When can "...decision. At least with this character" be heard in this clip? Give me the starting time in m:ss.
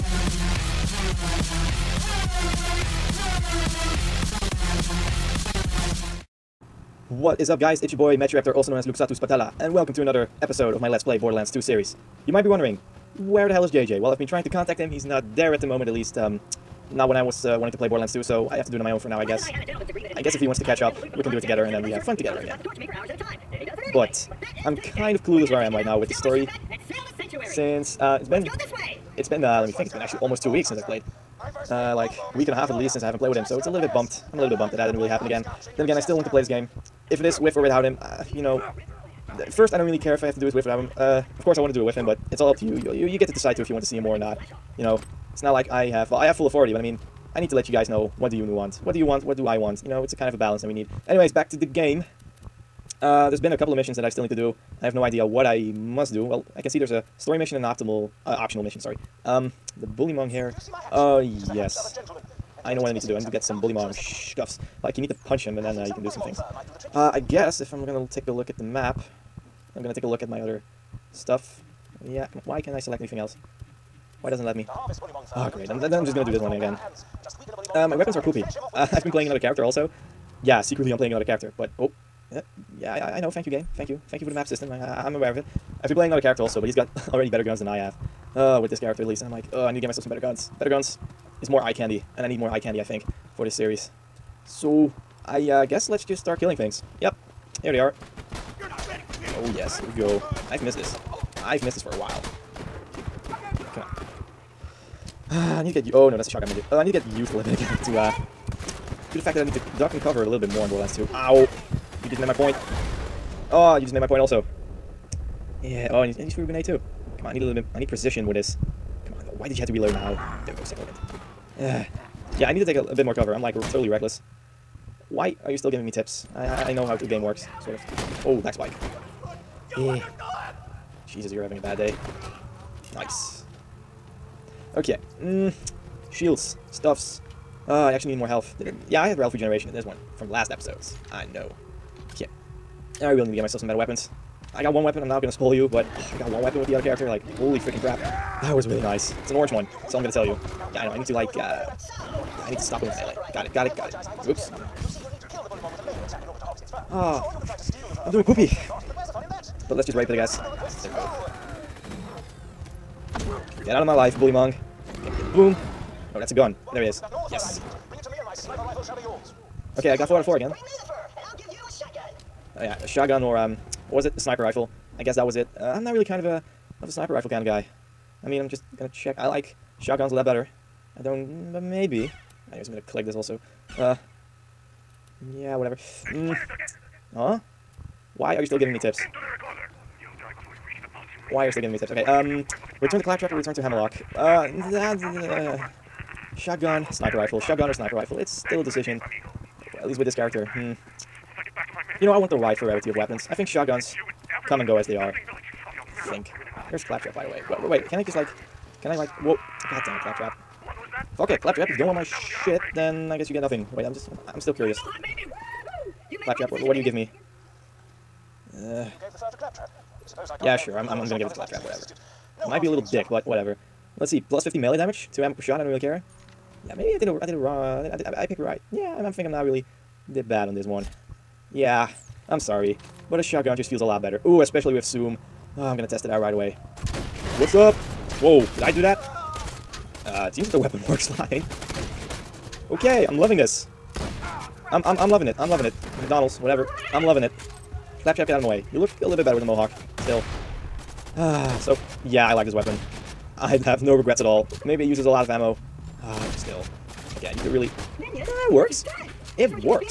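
3:18.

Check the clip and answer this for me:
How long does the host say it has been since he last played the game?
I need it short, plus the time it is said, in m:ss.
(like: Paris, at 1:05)
almost two weeks, at 0:30.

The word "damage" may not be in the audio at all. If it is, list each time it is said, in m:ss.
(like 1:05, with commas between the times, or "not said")
3:44.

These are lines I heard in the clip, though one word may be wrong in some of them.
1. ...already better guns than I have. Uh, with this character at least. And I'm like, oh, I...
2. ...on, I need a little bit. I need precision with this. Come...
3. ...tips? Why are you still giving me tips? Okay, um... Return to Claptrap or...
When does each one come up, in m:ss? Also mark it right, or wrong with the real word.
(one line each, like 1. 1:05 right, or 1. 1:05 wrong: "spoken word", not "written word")
1. 1:27 right
2. 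1:57 right
3. 3:08 right.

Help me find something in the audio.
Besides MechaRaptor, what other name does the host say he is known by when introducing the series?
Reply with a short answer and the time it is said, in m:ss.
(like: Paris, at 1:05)
Luxatus Patella, at 0:08.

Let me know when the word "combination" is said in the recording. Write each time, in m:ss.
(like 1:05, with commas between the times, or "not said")
not said.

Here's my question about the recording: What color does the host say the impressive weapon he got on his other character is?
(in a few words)
orange.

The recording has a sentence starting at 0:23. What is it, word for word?
But I'm kind of clueless where I am right now with the story.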